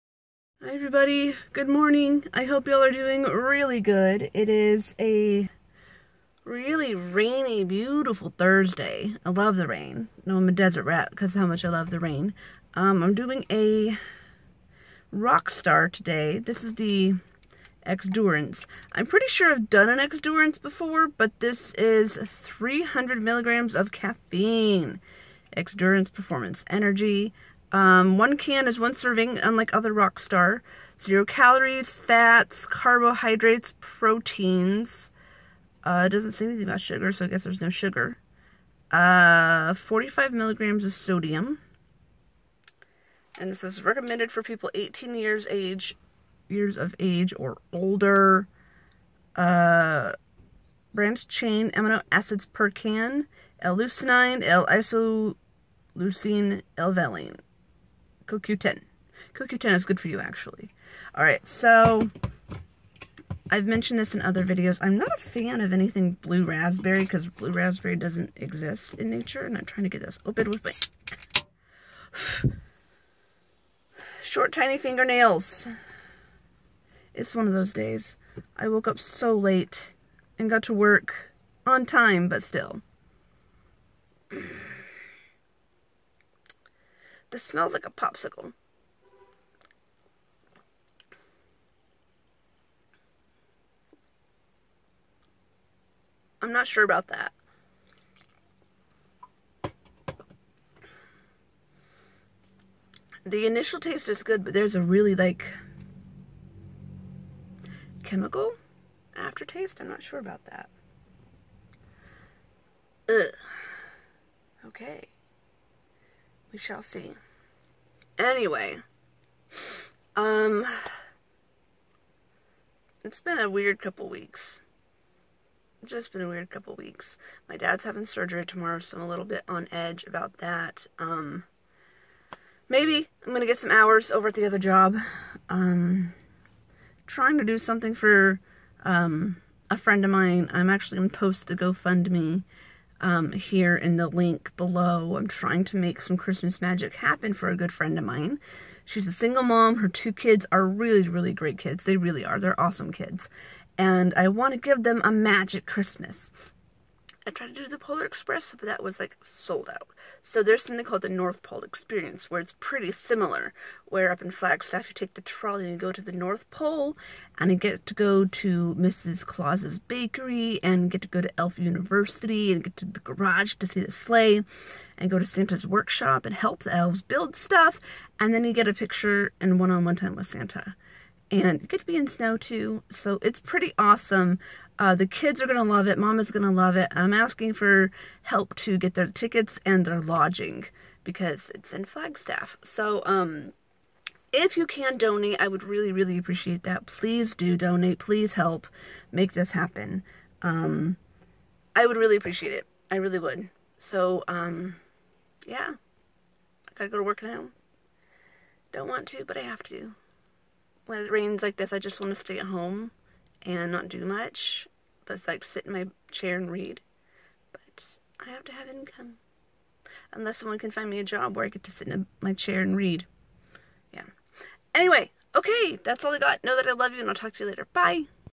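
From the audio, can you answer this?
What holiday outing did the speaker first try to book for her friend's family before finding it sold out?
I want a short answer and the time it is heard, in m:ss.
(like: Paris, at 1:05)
Polar Express, at 2:37.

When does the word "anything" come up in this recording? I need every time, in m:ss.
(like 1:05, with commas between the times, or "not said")
0:36, 1:05.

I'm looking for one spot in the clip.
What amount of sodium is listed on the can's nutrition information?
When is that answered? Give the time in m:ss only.
0:39.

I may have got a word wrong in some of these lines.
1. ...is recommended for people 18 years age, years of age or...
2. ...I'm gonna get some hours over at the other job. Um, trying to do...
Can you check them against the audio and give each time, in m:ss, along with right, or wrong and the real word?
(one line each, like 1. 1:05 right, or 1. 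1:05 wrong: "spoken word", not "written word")
1. 0:43 right
2. 2:13 right.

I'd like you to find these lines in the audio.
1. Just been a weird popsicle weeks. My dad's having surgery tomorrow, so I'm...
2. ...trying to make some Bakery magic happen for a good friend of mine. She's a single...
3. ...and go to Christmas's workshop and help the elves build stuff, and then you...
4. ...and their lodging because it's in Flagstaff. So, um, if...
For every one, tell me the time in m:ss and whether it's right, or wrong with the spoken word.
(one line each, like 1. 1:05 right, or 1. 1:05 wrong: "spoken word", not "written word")
1. 2:05 wrong: "couple", not "popsicle"
2. 2:25 wrong: "Christmas", not "Bakery"
3. 2:54 wrong: "Santa", not "Christmas"
4. 3:09 right.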